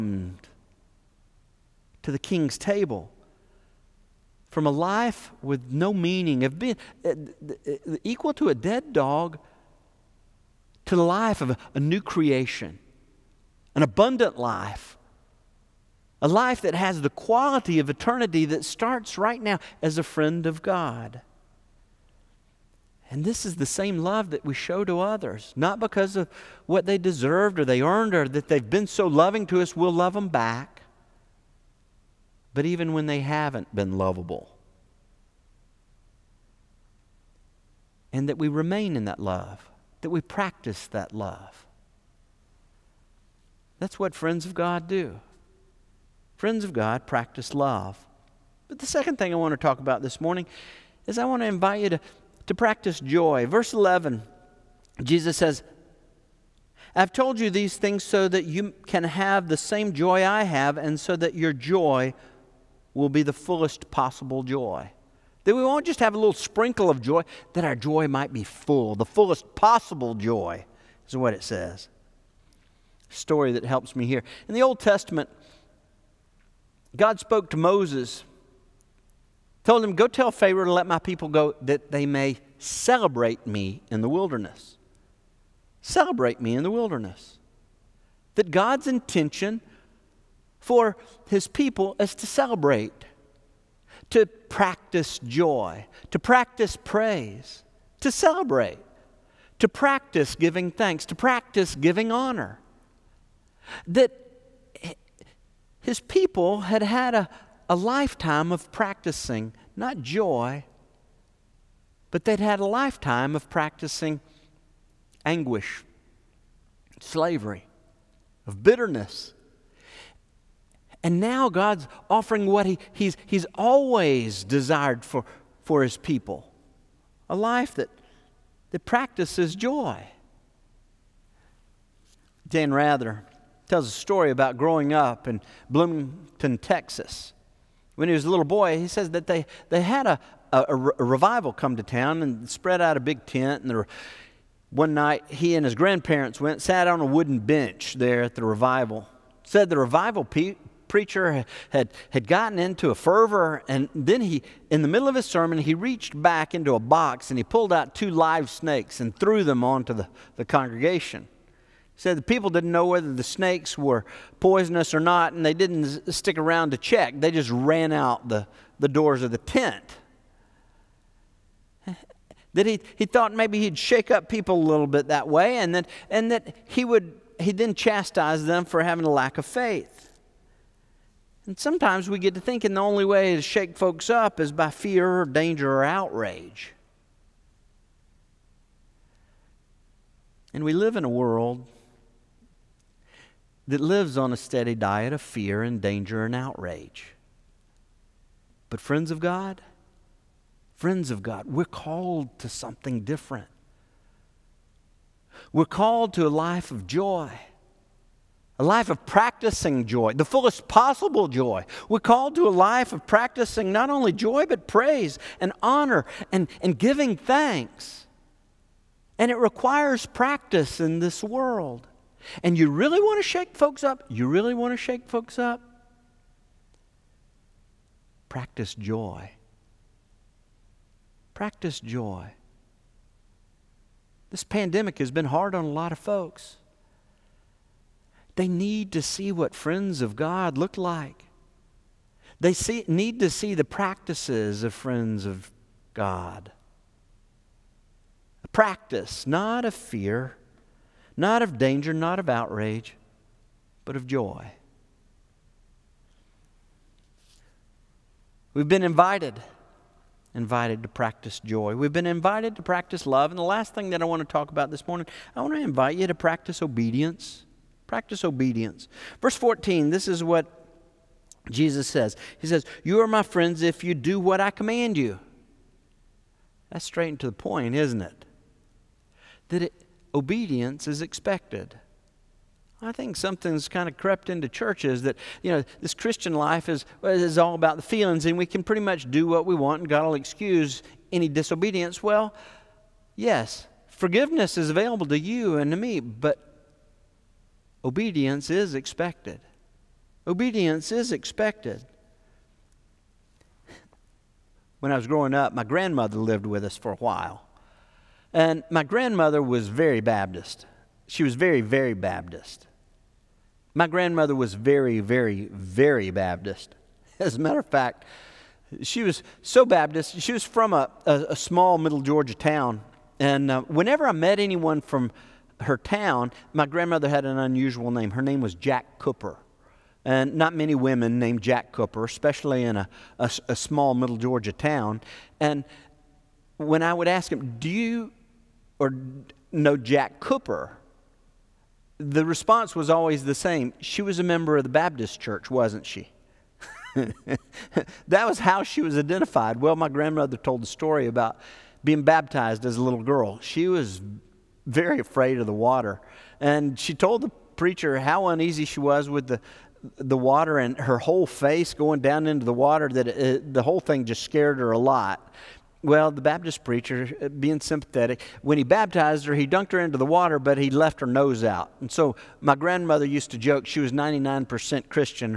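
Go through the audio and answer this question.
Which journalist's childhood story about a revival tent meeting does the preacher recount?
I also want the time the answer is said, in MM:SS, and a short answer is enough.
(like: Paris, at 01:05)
Dan Rather, at 02:12.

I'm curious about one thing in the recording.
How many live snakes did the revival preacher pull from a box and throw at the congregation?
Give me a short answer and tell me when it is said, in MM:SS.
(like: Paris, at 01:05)
2, at 02:37.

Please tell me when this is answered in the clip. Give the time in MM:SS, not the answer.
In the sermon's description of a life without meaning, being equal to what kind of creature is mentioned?
00:08.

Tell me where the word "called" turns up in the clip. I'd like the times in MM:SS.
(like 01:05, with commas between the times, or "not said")
03:21, 03:25, 03:31.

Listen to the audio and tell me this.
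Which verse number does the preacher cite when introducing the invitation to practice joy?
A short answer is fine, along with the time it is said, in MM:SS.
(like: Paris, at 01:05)
11, at 00:53.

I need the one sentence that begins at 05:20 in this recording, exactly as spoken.
She was from a, a, a small middle Georgia town.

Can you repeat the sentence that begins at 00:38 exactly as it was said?
And that we remain in that love, that we practice that love.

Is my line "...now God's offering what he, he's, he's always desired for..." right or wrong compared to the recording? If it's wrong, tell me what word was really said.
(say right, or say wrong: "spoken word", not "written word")
right.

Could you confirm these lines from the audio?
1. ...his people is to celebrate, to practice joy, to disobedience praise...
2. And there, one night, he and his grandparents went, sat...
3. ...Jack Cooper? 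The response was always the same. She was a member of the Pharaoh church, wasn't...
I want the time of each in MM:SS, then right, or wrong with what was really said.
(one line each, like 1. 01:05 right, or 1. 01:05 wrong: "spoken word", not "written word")
1. 01:31 wrong: "practice", not "disobedience"
2. 02:23 right
3. 05:39 wrong: "Baptist", not "Pharaoh".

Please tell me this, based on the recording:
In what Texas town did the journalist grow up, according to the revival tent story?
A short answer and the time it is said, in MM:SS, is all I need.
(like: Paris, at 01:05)
Bloomington, Texas, at 02:15.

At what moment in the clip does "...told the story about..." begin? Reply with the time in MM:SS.
05:50.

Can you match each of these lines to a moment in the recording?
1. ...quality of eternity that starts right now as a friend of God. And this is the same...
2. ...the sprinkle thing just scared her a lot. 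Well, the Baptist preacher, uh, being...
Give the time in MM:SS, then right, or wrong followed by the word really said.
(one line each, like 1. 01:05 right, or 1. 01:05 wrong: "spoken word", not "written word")
1. 00:17 right
2. 06:03 wrong: "whole", not "sprinkle".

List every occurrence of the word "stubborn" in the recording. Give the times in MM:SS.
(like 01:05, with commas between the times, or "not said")
not said.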